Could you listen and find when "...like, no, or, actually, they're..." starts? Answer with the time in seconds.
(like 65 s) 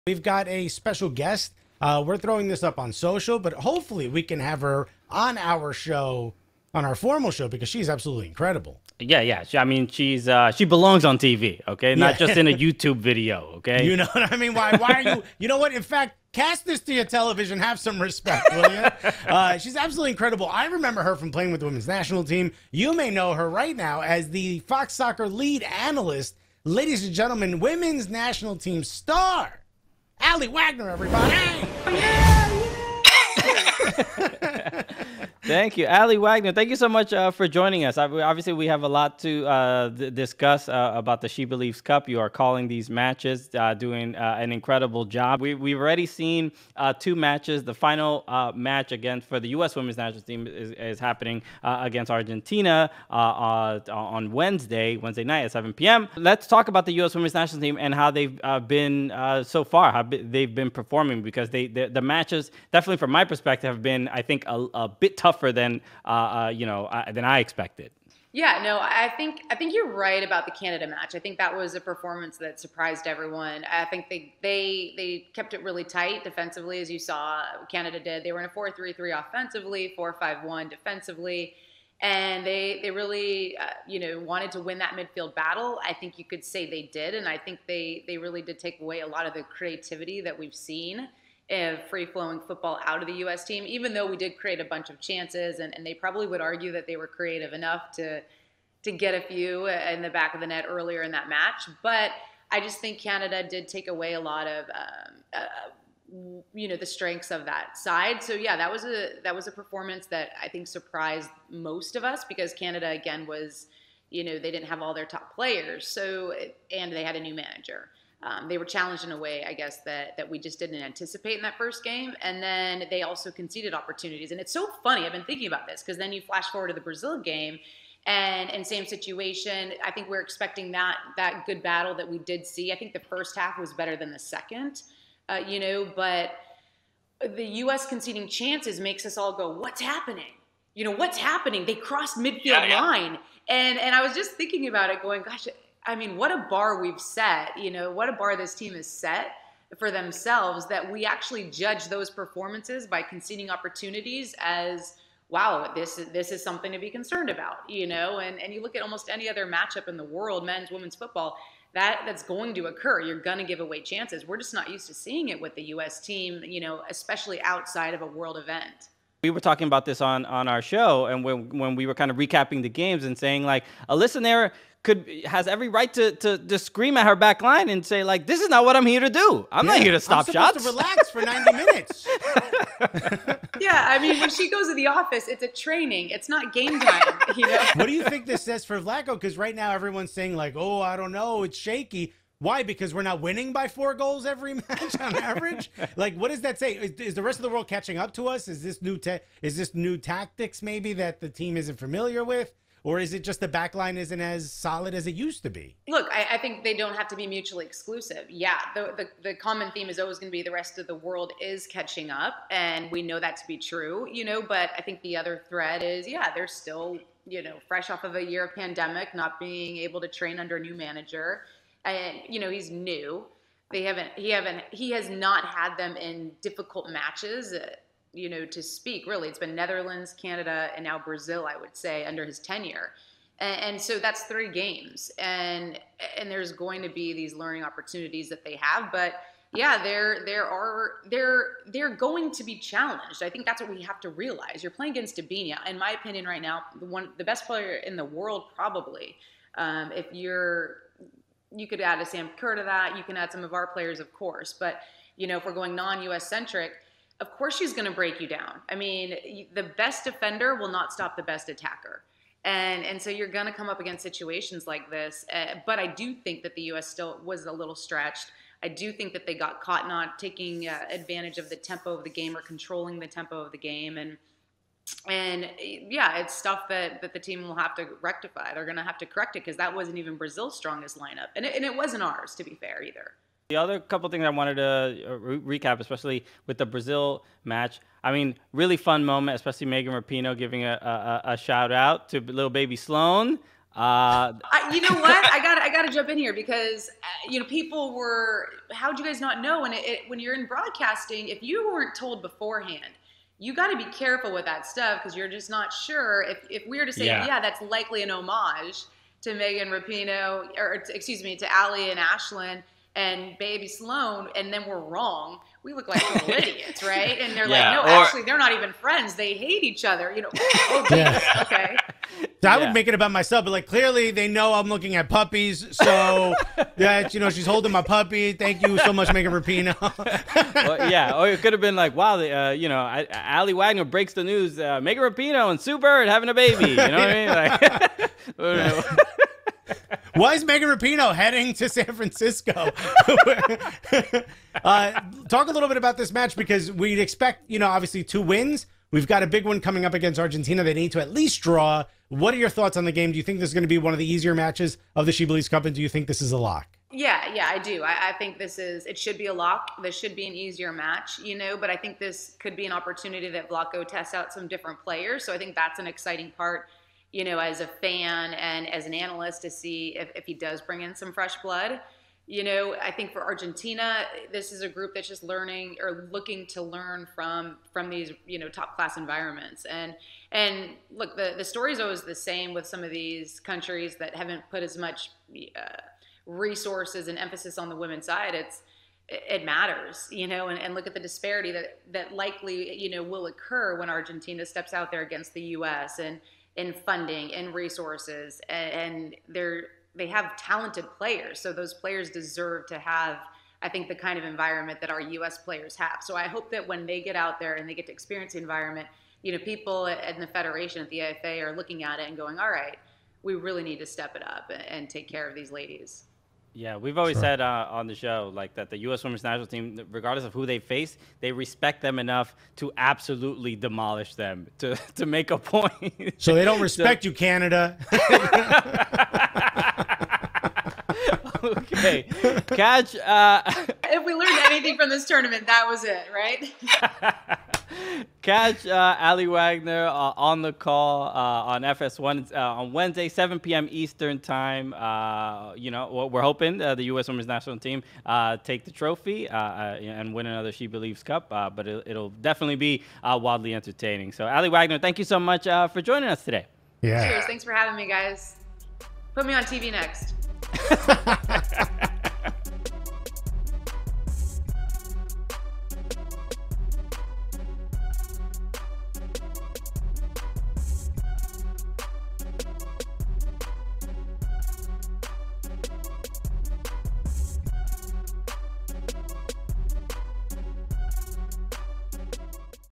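317 s.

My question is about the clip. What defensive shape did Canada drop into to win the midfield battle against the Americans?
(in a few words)
4-5-1.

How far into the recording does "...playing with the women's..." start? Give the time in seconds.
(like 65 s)
21 s.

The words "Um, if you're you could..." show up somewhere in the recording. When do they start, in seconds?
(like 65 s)
249 s.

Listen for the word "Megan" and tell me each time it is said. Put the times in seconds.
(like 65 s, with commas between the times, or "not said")
289 s, 309 s, 329 s, 334 s, 340 s.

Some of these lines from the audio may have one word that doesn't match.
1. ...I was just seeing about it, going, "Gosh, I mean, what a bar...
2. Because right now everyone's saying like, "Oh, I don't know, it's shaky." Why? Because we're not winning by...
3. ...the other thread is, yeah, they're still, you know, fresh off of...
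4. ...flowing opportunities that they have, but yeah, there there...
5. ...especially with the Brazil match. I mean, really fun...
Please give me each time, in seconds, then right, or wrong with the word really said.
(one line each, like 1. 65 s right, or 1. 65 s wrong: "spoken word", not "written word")
1. 143 s wrong: "thinking", not "seeing"
2. 189 s right
3. 215 s right
4. 237 s wrong: "learning", not "flowing"
5. 285 s right.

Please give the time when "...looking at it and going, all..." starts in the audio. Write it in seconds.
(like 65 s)
411 s.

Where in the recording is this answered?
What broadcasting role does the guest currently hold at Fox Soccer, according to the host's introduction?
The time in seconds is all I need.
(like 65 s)
25 s.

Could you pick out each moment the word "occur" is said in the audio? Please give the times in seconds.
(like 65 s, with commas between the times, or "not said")
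162 s, 393 s.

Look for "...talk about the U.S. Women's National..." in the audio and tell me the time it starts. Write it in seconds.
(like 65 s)
56 s.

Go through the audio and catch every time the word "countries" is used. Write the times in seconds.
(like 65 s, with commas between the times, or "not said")
383 s.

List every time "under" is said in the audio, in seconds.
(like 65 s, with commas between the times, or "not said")
220 s, 232 s.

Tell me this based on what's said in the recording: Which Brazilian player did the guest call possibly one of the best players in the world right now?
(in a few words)
Debinha.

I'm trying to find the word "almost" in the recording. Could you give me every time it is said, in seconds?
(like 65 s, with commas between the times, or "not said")
158 s.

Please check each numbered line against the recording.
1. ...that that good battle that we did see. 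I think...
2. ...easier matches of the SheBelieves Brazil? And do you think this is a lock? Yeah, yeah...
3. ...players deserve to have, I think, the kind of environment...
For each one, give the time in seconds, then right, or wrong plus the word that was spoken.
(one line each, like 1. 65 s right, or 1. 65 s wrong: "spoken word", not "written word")
1. 130 s right
2. 354 s wrong: "Cup", not "Brazil"
3. 401 s right.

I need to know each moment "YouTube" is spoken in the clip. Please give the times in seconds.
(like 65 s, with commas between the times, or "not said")
12 s.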